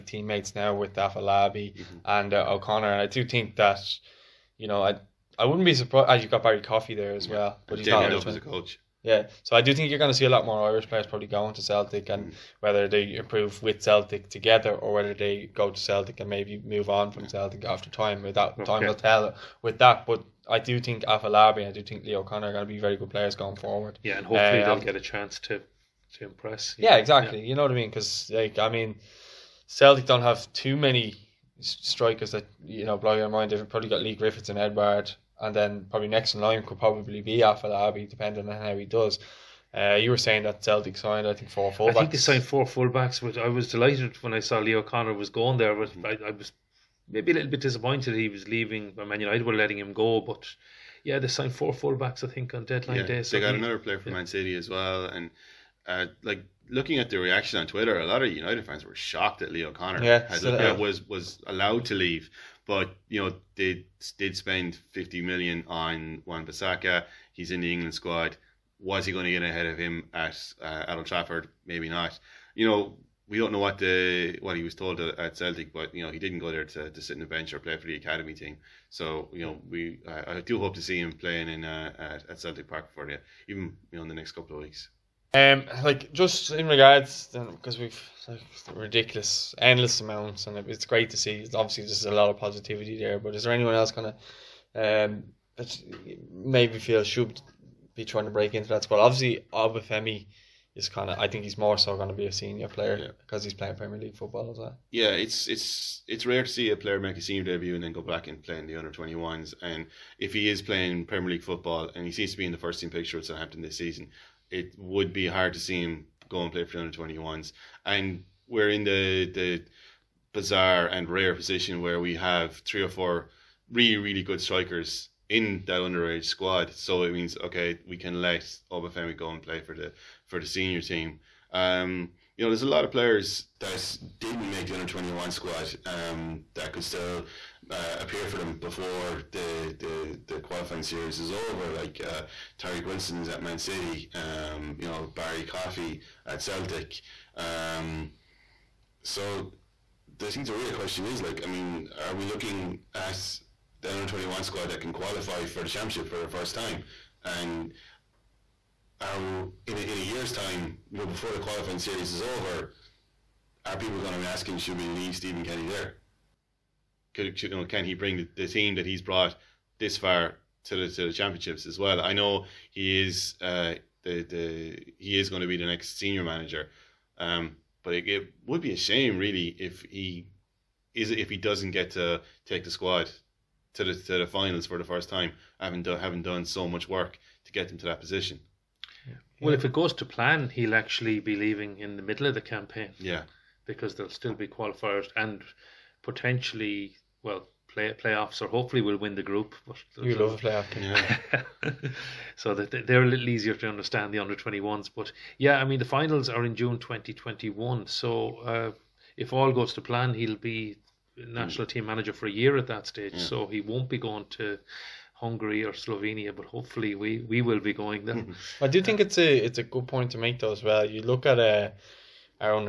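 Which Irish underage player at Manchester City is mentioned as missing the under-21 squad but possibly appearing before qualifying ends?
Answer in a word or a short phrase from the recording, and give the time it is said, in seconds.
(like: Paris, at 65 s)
Tyreke Wilson, at 142 s.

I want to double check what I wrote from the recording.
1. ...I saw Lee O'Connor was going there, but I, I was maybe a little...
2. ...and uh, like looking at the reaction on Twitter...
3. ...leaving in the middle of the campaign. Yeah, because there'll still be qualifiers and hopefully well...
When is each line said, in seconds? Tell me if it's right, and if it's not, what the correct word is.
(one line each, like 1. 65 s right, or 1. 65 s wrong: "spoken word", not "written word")
1. 44 s right
2. 55 s right
3. 191 s wrong: "potentially", not "hopefully".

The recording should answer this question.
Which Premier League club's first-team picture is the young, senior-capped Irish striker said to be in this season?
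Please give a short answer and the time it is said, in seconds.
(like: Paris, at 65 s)
Southampton, at 113 s.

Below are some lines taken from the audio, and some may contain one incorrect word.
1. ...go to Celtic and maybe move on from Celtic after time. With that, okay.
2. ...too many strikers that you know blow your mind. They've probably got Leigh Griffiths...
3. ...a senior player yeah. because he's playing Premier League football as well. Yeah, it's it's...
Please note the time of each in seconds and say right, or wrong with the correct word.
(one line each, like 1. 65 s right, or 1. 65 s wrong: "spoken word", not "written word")
1. 15 s right
2. 30 s right
3. 102 s right.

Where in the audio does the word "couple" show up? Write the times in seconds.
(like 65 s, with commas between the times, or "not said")
84 s.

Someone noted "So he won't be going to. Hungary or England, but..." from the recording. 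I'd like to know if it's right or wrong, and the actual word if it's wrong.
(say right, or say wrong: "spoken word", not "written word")
wrong: "Slovenia", not "England".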